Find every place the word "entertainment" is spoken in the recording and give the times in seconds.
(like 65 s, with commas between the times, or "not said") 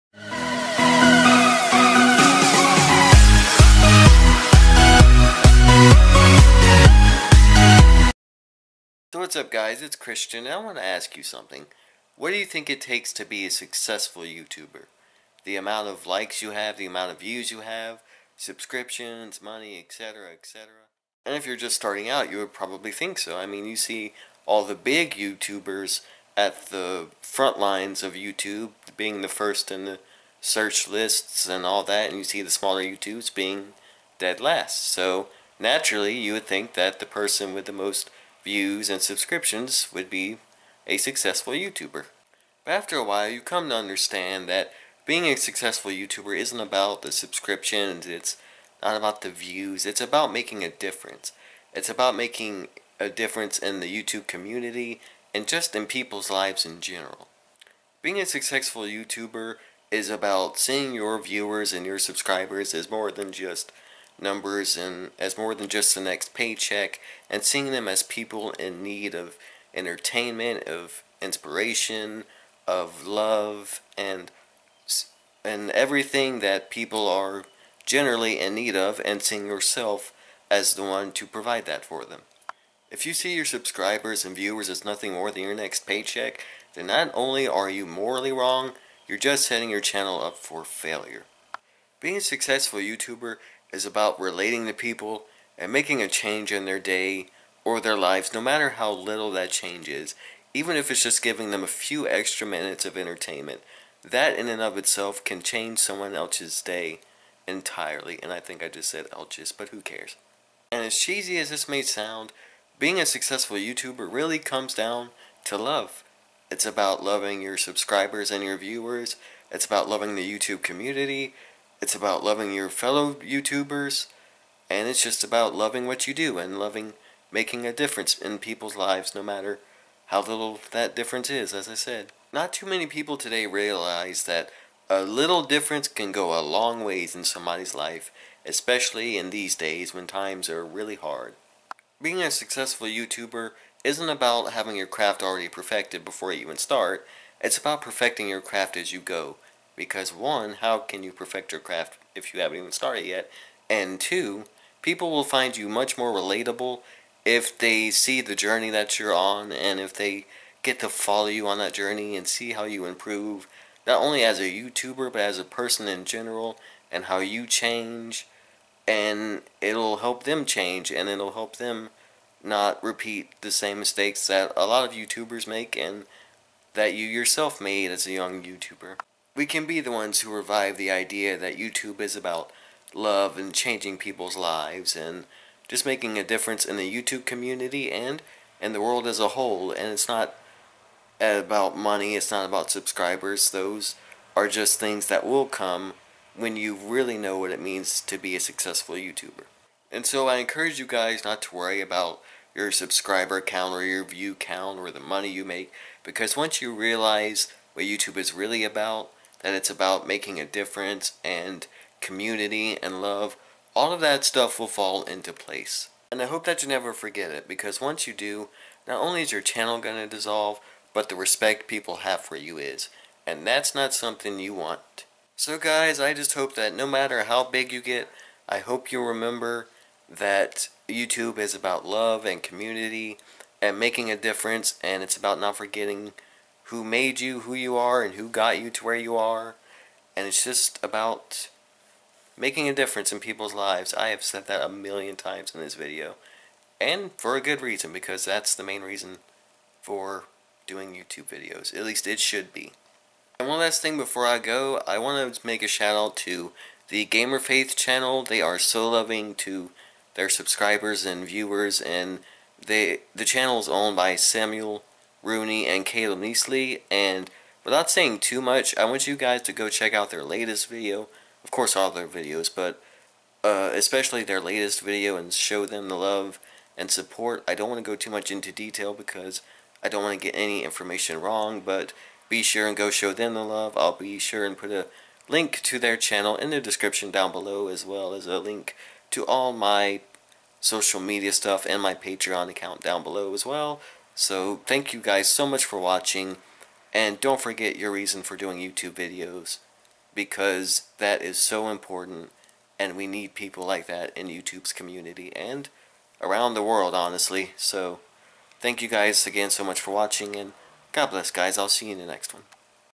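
69 s, 102 s.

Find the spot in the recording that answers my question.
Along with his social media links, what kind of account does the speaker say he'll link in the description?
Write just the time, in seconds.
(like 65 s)
291 s.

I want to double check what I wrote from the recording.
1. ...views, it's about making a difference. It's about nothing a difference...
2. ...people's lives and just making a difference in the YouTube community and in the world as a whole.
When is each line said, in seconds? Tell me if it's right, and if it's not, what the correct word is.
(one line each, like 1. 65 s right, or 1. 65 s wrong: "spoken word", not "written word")
1. 49 s wrong: "making", not "nothing"
2. 183 s right.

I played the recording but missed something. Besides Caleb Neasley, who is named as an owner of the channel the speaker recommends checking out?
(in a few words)
Samuel Rooney.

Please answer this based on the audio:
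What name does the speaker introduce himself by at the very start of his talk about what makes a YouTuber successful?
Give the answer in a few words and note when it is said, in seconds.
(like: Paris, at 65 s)
Christian, at 9 s.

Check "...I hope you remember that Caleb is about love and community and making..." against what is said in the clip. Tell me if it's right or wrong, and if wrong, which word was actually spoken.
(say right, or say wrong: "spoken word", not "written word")
wrong: "YouTube", not "Caleb".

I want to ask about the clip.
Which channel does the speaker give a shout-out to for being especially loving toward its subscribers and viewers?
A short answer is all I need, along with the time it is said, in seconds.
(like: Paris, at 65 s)
Gamer Faith, at 257 s.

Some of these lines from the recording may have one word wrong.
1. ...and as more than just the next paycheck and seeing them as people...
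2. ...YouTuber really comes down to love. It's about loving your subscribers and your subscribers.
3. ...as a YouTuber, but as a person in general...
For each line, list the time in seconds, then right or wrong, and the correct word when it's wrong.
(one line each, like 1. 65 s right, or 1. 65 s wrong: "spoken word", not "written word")
1. 64 s right
2. 113 s wrong: "viewers", not "subscribers"
3. 164 s right.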